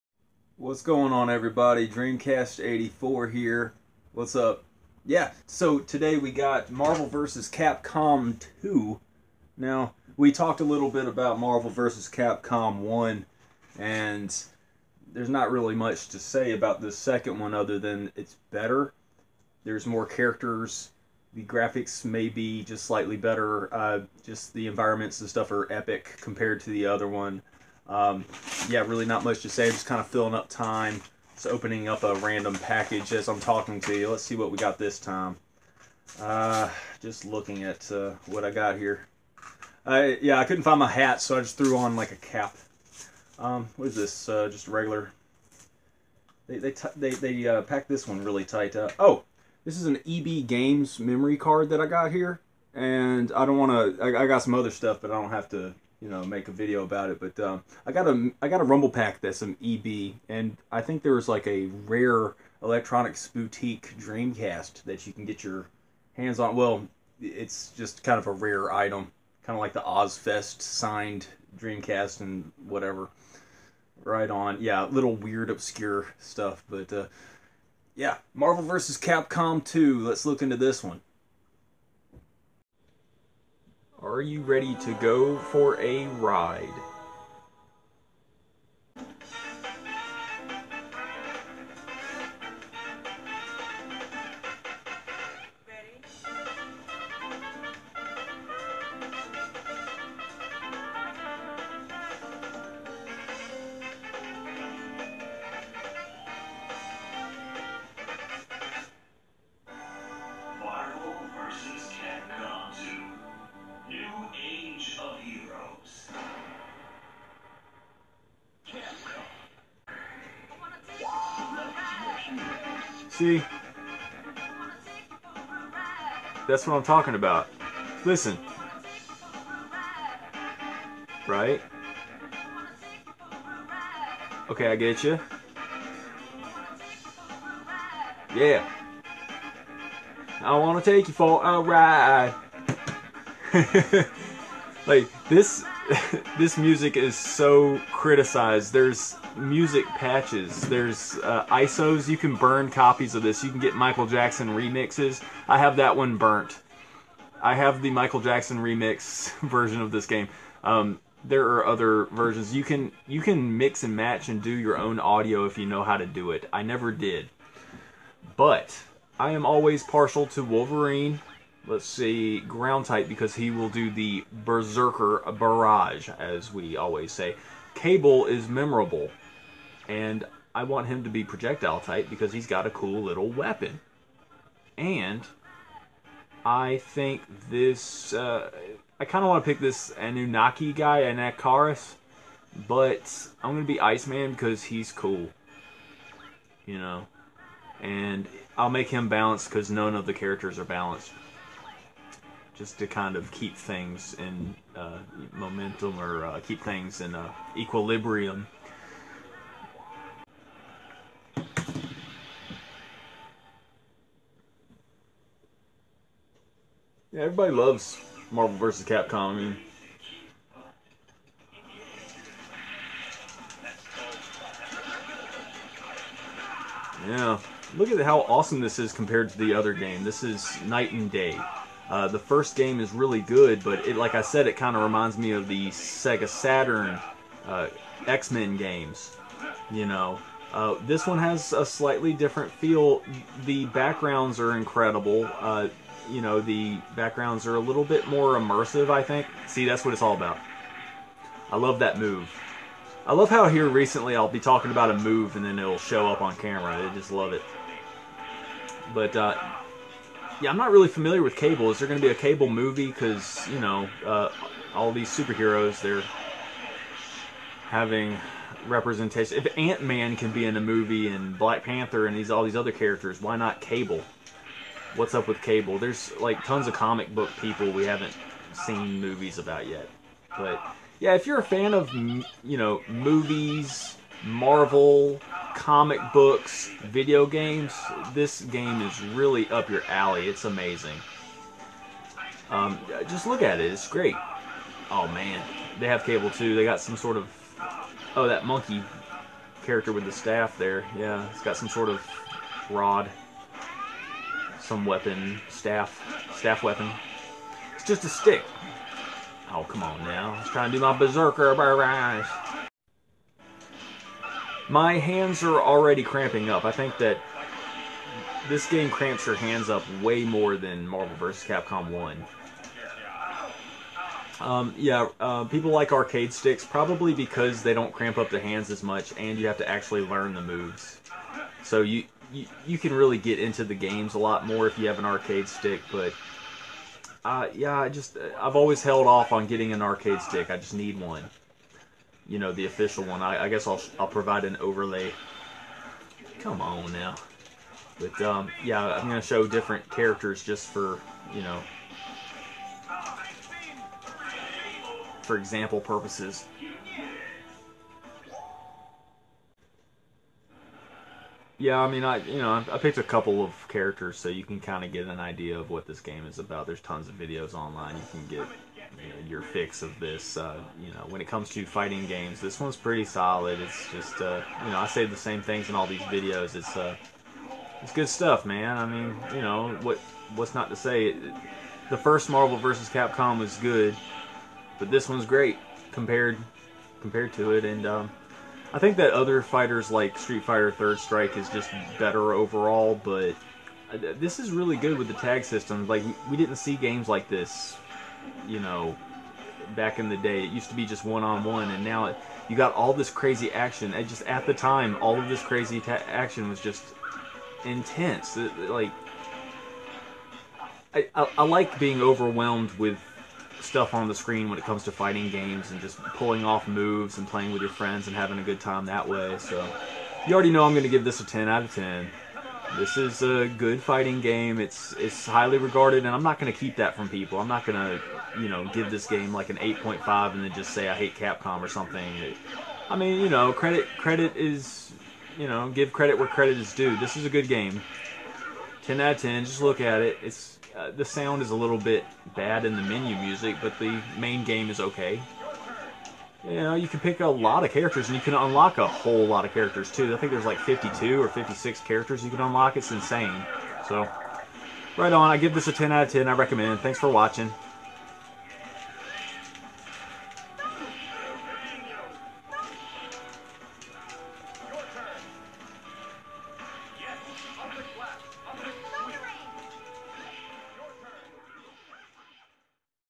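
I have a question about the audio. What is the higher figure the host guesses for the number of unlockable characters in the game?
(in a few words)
56.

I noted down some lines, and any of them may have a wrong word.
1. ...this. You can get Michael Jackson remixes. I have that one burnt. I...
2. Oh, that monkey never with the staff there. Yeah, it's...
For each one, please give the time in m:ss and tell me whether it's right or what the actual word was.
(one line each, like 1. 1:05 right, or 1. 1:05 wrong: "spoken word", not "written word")
1. 2:33 right
2. 4:58 wrong: "character", not "never".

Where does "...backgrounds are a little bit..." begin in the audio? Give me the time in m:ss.
4:06.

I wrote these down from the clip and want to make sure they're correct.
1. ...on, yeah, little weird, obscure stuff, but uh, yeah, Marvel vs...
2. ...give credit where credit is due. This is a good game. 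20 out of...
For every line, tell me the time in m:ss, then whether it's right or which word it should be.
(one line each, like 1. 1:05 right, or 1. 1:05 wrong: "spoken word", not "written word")
1. 1:14 right
2. 7:15 wrong: "10", not "20".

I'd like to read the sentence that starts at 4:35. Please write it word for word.
There's like tons of comic book people we haven't seen movies about yet.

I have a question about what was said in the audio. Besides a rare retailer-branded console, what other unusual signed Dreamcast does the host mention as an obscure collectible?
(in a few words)
Ozzfest.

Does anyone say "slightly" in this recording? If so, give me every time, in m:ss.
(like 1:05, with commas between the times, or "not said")
0:22, 4:01.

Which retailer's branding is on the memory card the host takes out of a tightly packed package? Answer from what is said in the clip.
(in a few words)
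EB Games.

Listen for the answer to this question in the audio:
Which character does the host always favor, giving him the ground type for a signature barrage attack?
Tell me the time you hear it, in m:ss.
2:50.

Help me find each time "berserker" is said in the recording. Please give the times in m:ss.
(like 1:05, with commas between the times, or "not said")
2:54, 5:10.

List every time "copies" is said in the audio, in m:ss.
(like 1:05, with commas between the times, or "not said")
2:32.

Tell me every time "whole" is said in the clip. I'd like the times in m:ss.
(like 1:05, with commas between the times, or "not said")
7:28.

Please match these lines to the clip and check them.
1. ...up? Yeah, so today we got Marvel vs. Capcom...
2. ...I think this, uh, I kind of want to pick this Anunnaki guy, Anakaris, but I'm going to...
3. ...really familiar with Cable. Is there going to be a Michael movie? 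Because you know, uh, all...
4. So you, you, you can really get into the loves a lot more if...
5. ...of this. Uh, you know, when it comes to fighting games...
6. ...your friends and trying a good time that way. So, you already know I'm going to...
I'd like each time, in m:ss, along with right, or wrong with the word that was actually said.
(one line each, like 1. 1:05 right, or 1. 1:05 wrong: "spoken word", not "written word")
1. 0:04 right
2. 3:06 right
3. 4:20 wrong: "Cable", not "Michael"
4. 5:31 wrong: "games", not "loves"
5. 6:09 right
6. 6:57 wrong: "having", not "trying".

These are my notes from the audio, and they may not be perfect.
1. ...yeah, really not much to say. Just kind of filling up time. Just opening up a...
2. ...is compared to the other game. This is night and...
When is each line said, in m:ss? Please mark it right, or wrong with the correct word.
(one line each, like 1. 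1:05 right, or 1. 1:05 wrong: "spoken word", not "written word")
1. 0:28 right
2. 3:48 right.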